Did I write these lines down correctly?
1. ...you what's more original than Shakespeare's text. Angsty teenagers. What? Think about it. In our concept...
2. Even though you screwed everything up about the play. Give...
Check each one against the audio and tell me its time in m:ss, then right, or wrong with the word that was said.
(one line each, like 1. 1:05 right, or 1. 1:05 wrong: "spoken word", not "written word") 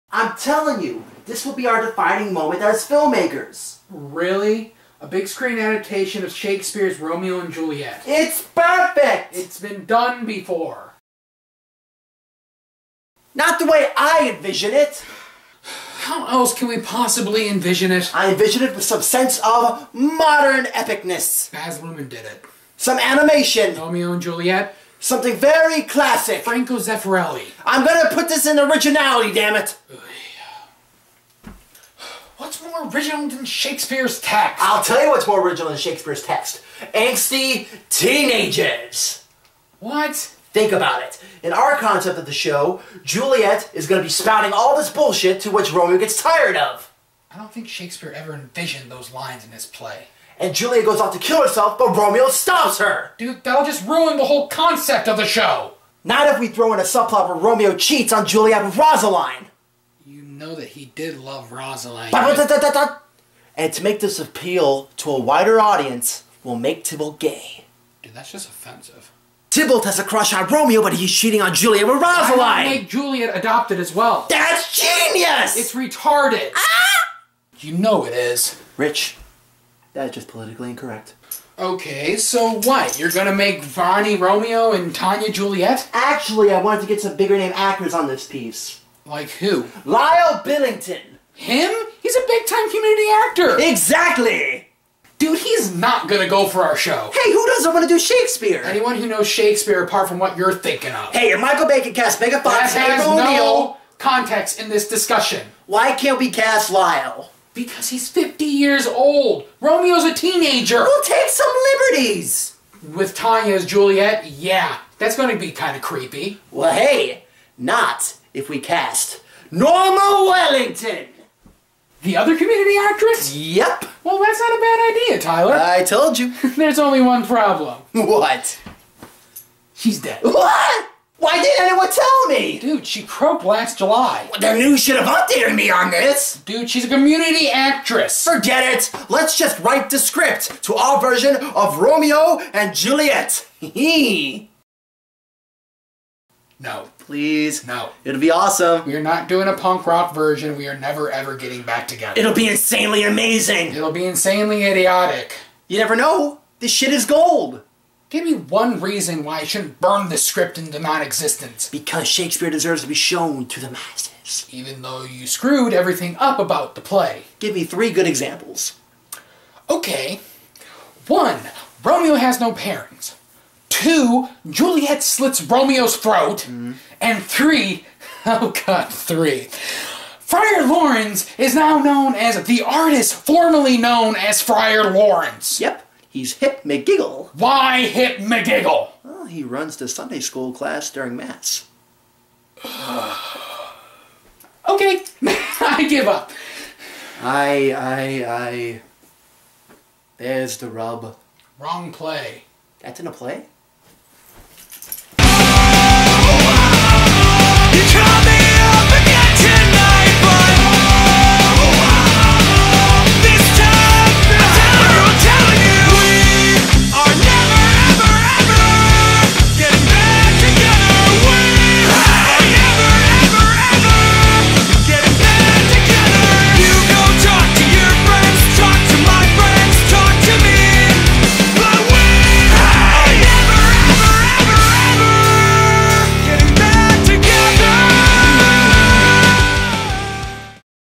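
1. 0:35 right
2. 2:44 right.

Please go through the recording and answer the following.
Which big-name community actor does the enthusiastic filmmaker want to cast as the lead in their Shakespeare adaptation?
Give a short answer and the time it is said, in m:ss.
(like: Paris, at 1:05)
Lyle Billington, at 1:29.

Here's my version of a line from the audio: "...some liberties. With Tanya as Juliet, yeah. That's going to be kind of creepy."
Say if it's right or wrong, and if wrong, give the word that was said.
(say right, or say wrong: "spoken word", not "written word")
right.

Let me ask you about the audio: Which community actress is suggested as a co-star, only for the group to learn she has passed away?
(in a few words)
Norma Wellington.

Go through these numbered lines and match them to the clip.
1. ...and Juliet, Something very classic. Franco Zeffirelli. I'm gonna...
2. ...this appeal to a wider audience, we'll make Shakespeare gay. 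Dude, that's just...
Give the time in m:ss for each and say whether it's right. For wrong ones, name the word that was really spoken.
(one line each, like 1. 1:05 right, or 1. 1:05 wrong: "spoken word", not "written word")
1. 0:24 right
2. 1:03 wrong: "Tybalt", not "Shakespeare".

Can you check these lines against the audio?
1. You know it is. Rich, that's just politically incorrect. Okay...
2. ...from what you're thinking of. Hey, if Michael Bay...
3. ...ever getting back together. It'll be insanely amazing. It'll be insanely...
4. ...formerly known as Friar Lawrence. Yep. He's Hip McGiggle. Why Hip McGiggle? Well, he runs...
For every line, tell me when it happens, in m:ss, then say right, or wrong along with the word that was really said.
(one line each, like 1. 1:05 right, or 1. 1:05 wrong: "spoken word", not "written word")
1. 1:17 right
2. 1:40 right
3. 2:31 right
4. 3:03 right.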